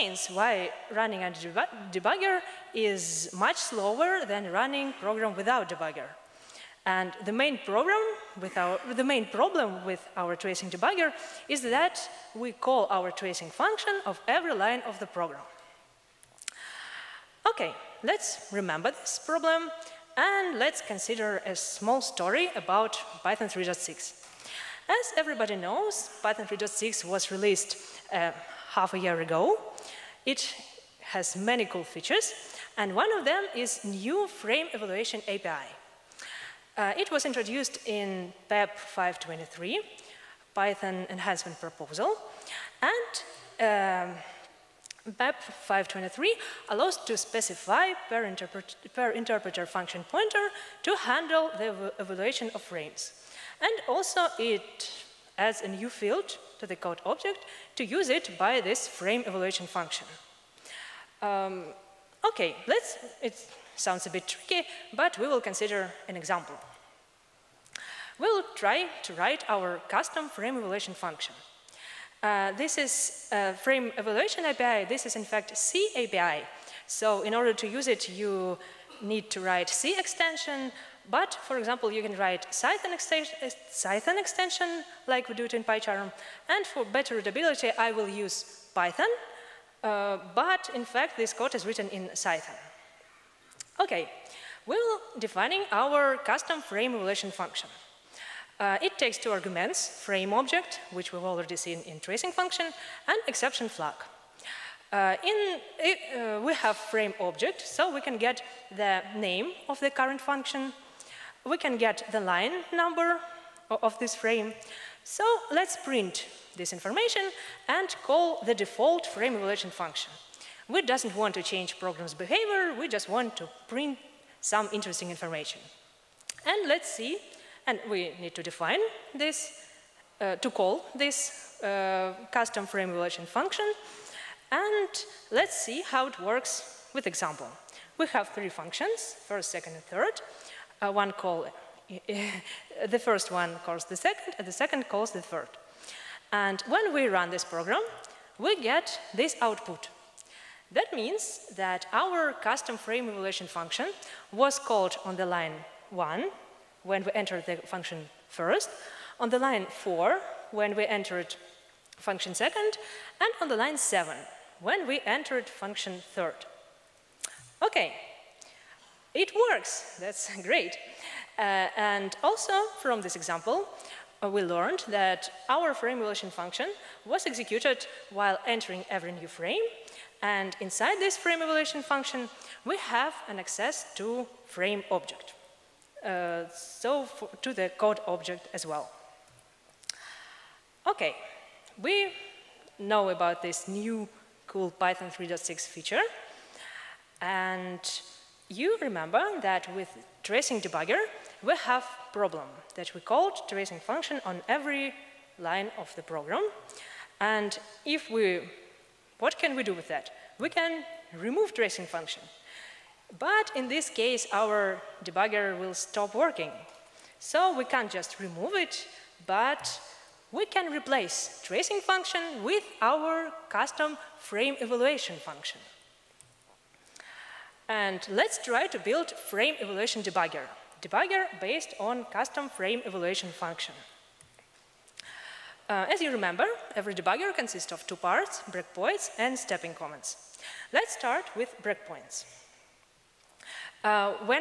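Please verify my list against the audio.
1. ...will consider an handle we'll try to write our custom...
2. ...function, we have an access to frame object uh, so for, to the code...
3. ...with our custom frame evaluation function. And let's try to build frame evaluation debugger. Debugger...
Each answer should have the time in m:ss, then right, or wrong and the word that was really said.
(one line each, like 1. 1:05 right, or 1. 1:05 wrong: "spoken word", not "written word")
1. 1:05 wrong: "example", not "handle"
2. 3:01 right
3. 3:42 right.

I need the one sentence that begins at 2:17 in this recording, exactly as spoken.
We have three functions, first, second, and third.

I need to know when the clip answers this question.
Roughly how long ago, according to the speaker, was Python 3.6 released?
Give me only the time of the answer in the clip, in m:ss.
0:28.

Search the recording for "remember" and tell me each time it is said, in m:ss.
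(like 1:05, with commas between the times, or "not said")
0:18, 3:18, 3:56.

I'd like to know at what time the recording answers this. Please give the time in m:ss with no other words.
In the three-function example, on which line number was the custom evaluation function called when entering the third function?
2:43.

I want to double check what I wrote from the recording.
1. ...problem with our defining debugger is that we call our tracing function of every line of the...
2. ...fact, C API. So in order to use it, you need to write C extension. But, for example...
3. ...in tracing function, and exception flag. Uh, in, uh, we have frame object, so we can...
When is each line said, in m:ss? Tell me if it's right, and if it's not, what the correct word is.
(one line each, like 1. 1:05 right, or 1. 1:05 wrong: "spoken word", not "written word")
1. 0:09 wrong: "tracing", not "defining"
2. 1:15 right
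3. 1:41 right.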